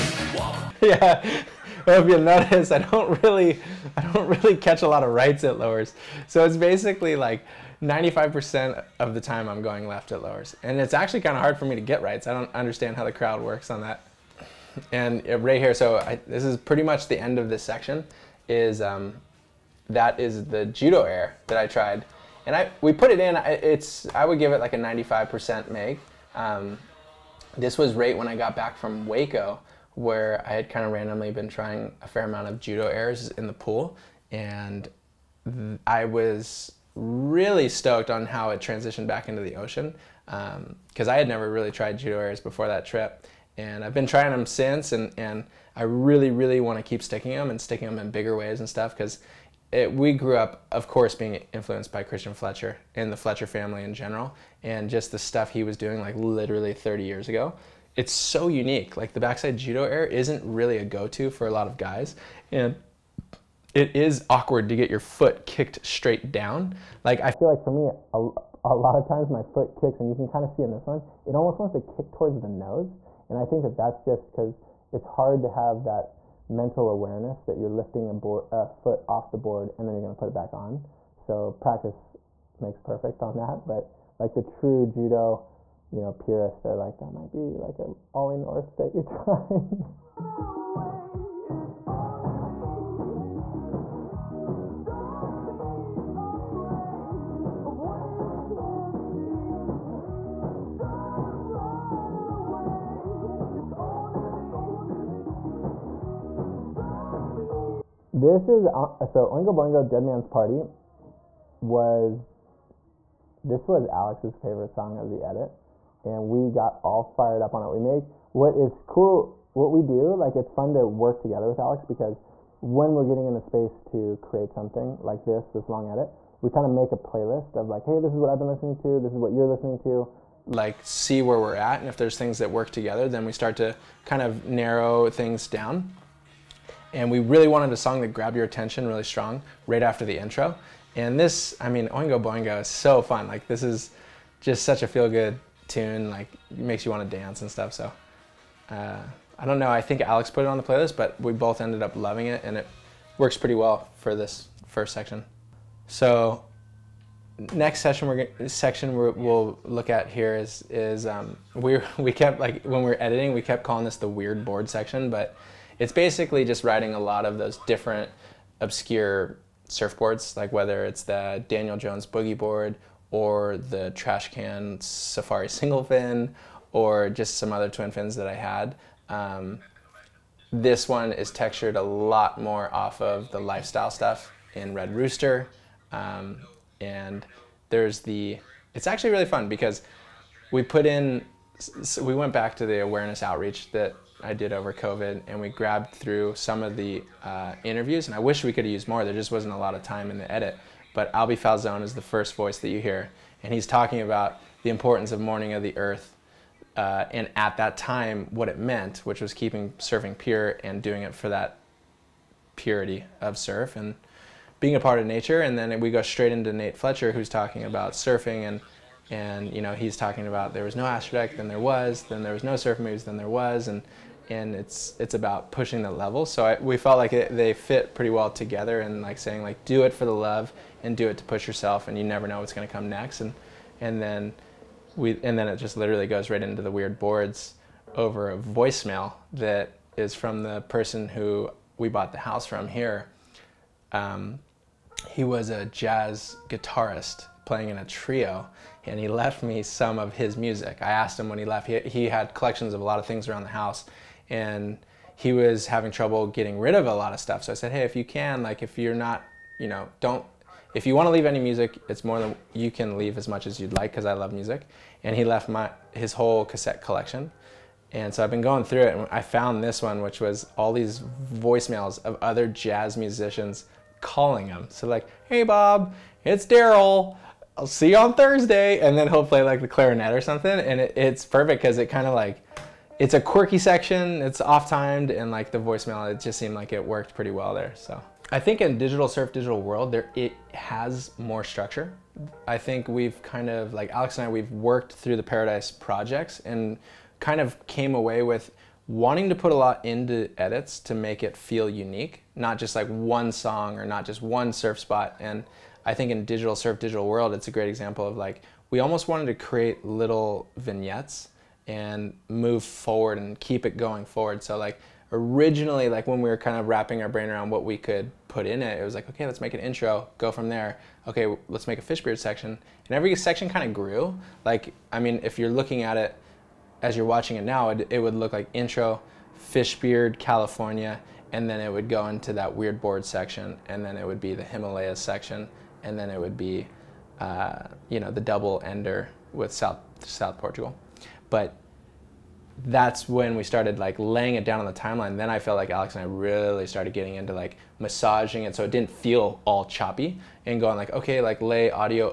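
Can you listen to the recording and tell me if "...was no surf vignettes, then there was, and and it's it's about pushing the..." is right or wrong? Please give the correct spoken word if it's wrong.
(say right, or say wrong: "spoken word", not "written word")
wrong: "moves", not "vignettes".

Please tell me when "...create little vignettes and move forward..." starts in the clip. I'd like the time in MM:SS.
05:09.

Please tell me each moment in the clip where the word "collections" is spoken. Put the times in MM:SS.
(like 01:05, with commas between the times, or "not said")
04:12, 04:26.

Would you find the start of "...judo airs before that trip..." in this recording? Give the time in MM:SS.
00:41.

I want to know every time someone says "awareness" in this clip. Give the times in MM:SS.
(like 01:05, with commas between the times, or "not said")
01:16, 03:12.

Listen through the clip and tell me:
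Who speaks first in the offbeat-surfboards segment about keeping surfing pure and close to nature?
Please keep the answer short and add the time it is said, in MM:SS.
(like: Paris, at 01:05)
Alby Falzon, at 03:21.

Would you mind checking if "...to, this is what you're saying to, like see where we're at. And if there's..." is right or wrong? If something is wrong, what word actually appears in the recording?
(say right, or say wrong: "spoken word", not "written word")
wrong: "listening", not "saying".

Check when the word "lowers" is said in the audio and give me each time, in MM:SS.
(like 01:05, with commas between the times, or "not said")
00:05, 00:10.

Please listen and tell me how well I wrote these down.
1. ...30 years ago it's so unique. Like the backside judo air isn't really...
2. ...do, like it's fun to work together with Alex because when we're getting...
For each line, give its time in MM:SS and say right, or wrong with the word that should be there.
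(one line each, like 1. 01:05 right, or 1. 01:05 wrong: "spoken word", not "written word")
1. 00:56 right
2. 01:59 right.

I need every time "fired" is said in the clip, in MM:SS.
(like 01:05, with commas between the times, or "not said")
01:57.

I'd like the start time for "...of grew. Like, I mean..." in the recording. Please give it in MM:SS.
05:23.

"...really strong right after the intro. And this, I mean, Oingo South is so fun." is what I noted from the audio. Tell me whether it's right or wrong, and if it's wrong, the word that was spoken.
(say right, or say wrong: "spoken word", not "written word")
wrong: "Boingo", not "South".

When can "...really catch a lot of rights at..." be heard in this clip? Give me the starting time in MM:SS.
00:04.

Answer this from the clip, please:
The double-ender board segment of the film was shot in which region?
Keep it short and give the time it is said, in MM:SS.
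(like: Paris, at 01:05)
South Portugal, at 05:40.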